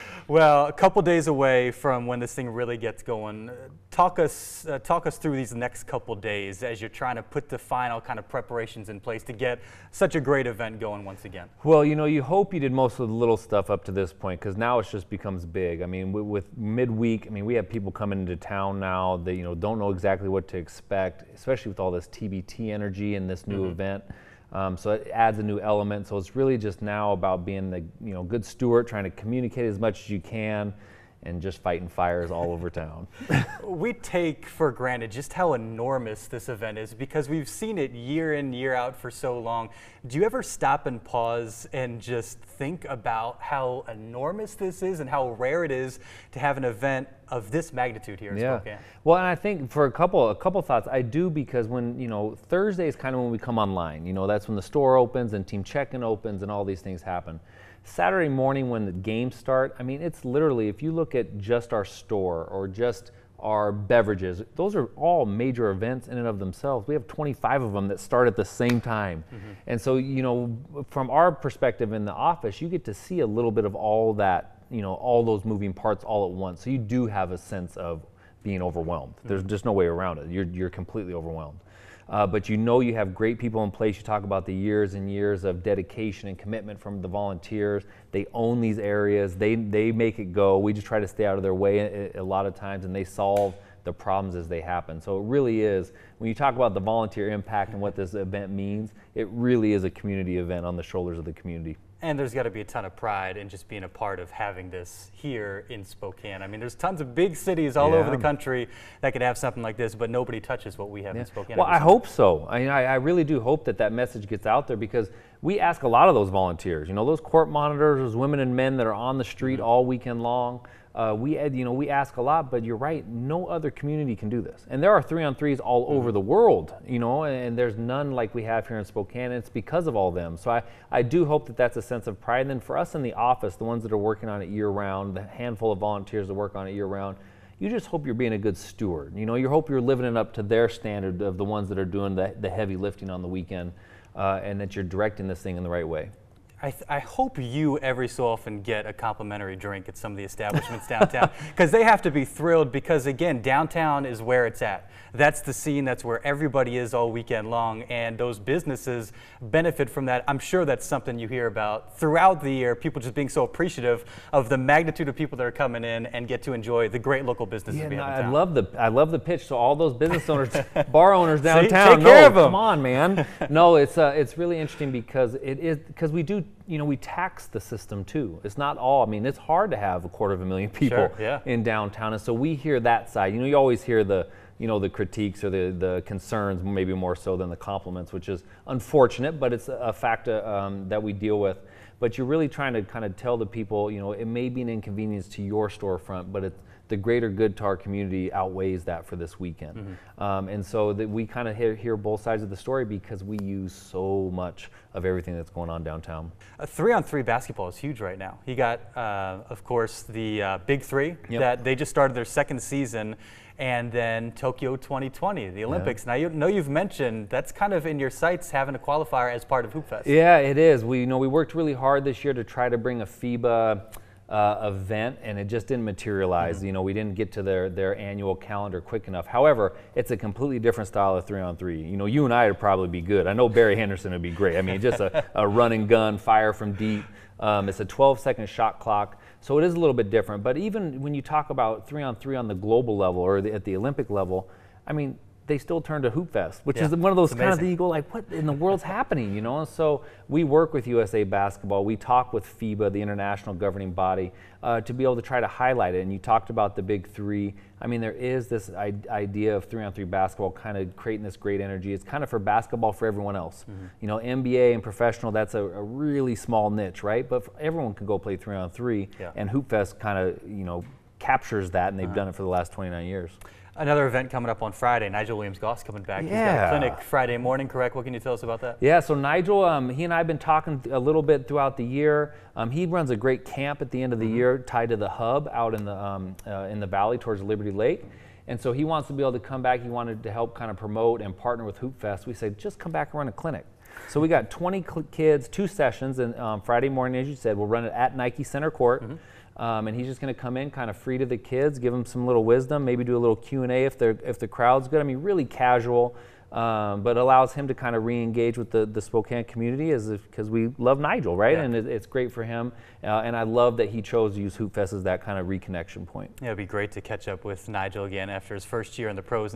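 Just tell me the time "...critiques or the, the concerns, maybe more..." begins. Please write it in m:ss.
3:04.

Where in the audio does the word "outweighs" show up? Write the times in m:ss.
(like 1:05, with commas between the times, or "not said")
3:18.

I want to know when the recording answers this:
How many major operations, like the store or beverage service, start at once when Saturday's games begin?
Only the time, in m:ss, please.
1:07.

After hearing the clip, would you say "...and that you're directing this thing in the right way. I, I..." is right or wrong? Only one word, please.
right.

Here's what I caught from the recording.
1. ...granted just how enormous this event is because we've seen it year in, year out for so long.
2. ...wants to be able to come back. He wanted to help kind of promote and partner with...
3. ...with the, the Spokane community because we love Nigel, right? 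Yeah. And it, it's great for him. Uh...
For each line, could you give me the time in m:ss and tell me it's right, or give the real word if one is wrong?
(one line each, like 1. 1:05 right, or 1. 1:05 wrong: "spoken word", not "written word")
1. 0:34 right
2. 4:48 right
3. 5:08 right.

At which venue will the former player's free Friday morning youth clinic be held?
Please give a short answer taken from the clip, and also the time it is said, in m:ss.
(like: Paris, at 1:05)
Nike Center Court, at 4:58.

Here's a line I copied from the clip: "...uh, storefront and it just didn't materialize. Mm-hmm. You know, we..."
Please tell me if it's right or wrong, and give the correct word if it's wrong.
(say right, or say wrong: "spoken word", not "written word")
wrong: "event", not "storefront".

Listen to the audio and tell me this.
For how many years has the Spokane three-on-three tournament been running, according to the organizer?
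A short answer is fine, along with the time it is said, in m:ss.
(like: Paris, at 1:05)
29, at 4:32.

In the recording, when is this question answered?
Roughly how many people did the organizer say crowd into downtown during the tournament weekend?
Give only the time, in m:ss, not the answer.
3:00.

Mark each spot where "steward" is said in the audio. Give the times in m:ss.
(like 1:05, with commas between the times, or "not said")
0:28, 2:18.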